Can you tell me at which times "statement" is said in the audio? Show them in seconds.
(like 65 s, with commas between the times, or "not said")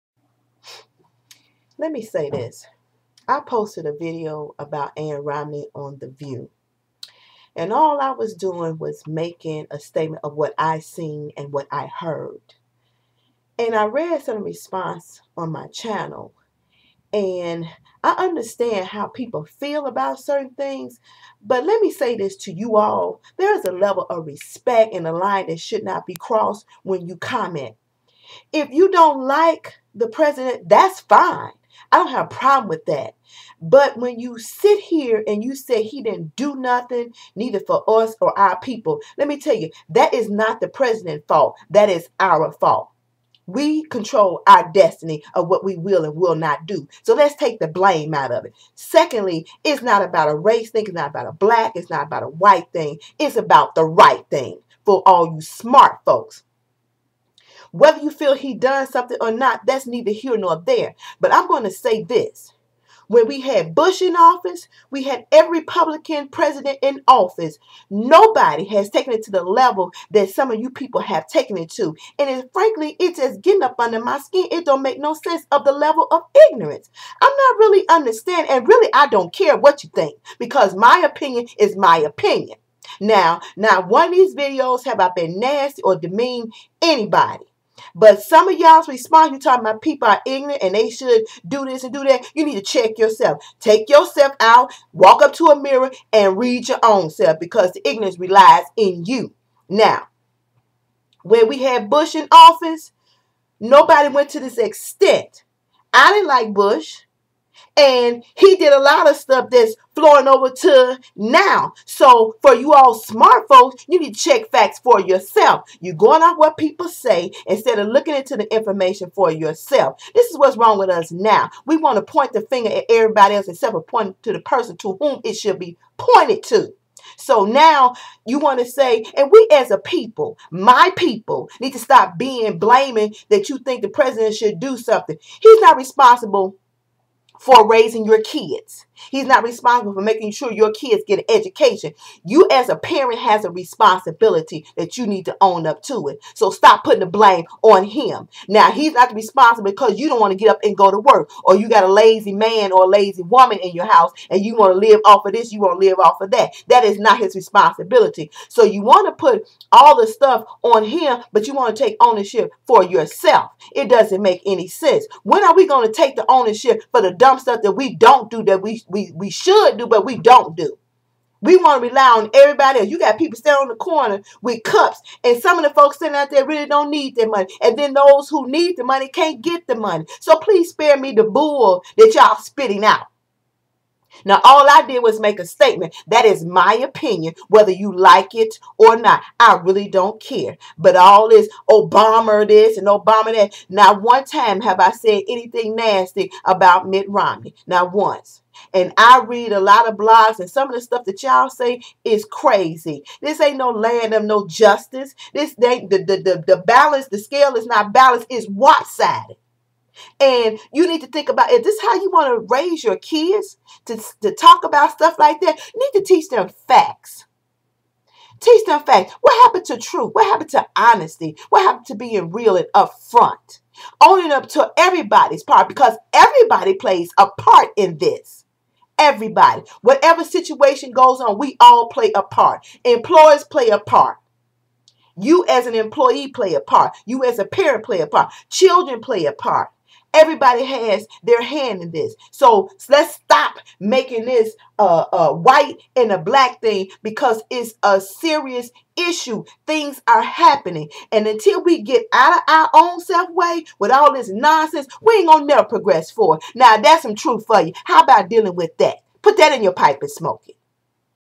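9 s, 185 s.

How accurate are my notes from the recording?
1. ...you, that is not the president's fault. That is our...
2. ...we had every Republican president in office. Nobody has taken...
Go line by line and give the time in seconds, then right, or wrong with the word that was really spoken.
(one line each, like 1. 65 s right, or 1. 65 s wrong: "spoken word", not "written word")
1. 39 s right
2. 64 s right.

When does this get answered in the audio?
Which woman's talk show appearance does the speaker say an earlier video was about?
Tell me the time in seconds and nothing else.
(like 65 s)
4 s.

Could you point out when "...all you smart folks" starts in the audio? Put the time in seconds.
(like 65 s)
55 s.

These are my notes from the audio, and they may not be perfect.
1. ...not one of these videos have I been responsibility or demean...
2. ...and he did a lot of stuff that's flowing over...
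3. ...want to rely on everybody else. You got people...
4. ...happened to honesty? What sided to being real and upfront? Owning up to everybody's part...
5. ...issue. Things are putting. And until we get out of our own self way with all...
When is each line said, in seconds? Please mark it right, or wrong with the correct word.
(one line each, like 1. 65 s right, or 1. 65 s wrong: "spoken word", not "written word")
1. 83 s wrong: "nasty", not "responsibility"
2. 107 s right
3. 171 s right
4. 220 s wrong: "happened", not "sided"
5. 248 s wrong: "happening", not "putting".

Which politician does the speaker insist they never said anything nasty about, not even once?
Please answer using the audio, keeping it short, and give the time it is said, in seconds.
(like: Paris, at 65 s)
Mitt Romney, at 196 s.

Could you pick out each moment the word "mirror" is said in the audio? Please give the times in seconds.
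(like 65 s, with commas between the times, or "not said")
95 s.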